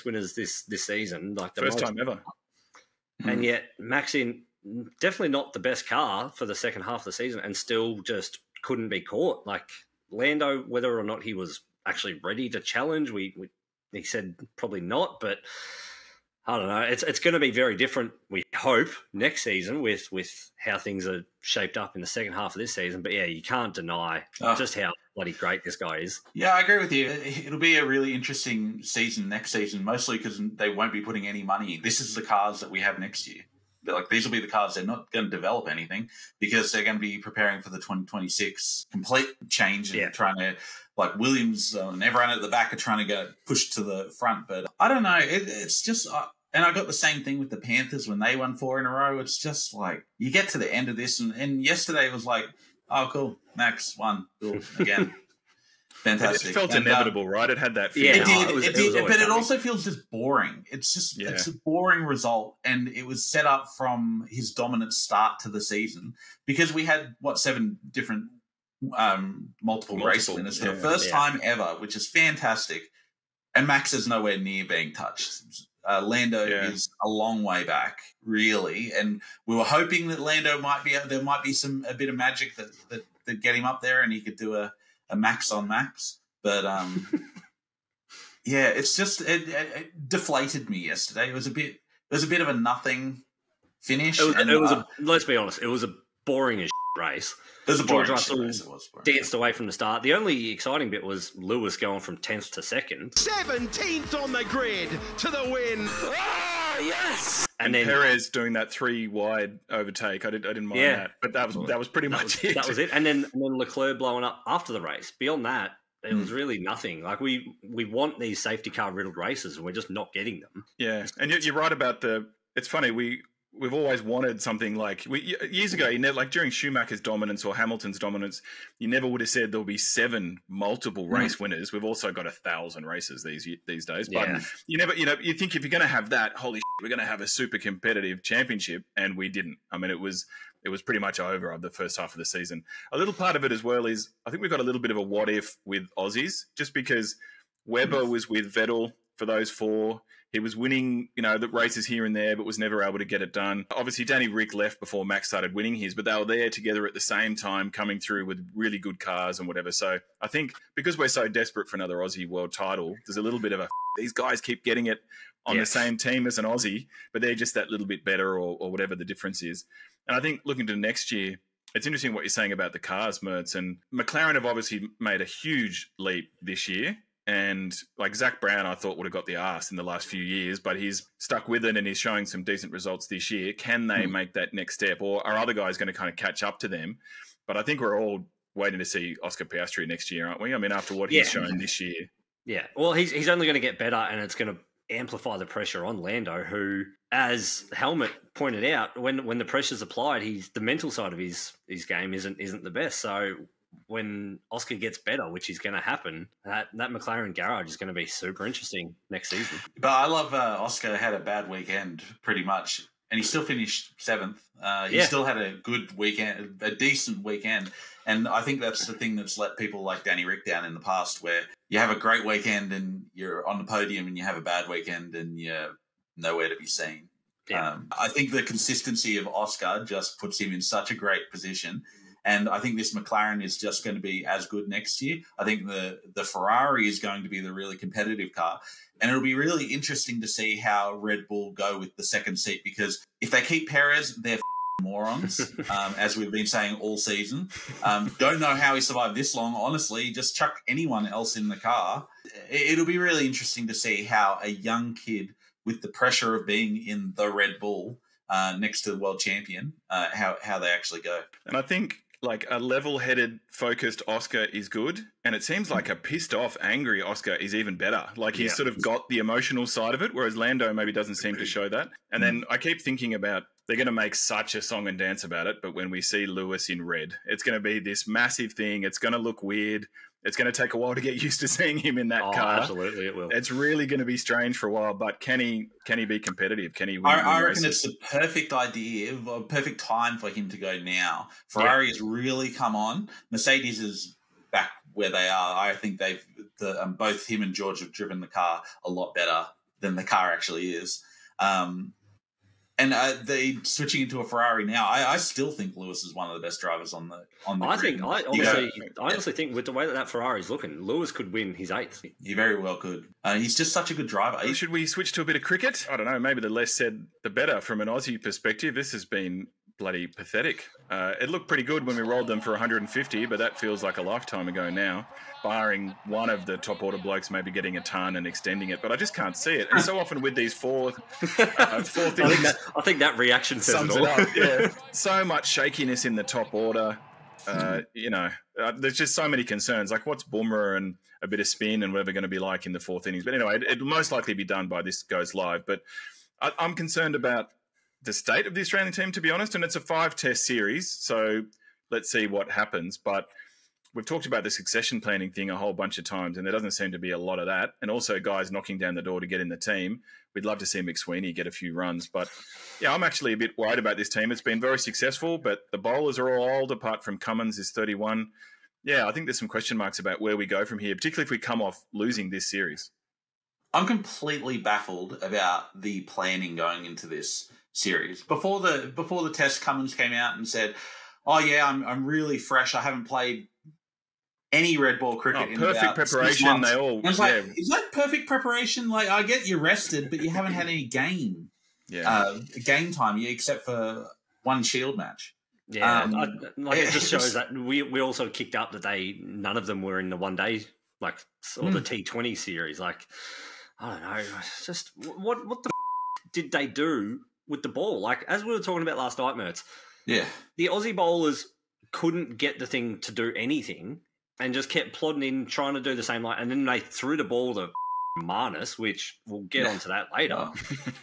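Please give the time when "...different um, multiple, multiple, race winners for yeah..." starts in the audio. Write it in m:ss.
1:07.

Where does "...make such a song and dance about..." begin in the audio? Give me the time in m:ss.
4:33.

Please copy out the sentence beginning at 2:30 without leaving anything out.
He was winning, you know, the races here and there, but was never able to get it done.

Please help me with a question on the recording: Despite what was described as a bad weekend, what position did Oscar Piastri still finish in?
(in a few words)
7th.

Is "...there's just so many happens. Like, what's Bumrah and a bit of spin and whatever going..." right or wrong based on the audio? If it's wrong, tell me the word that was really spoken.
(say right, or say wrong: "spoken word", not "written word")
wrong: "concerns", not "happens".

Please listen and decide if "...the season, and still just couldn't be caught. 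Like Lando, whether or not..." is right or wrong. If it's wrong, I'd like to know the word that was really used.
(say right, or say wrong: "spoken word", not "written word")
right.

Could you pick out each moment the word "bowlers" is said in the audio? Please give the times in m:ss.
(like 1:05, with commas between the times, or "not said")
6:05, 6:50.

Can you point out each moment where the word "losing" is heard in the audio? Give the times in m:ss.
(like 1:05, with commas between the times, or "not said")
6:11.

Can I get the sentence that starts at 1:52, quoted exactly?
And then and then Leclerc blowing up after the race.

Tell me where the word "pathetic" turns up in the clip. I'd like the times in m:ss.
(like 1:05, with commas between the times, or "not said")
5:20.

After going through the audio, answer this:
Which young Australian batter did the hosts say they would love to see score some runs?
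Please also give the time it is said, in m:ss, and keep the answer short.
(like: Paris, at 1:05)
McSweeney, at 6:00.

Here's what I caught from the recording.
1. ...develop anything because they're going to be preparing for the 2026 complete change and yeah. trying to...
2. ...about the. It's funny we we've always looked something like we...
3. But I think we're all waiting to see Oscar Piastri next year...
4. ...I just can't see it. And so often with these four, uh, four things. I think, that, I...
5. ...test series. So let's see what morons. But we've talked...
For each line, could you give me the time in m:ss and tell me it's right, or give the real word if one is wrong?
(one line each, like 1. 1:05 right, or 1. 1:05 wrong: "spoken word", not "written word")
1. 0:35 right
2. 2:01 wrong: "wanted", not "looked"
3. 3:07 right
4. 5:28 right
5. 5:50 wrong: "happens", not "morons".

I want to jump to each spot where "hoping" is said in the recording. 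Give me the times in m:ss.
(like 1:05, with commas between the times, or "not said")
1:19.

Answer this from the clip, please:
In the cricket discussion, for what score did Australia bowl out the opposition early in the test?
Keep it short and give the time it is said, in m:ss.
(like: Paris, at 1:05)
150, at 5:22.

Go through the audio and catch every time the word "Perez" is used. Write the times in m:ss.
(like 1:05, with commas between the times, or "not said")
1:47, 4:03.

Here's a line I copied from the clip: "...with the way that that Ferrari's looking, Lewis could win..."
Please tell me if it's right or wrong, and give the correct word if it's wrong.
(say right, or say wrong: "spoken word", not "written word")
right.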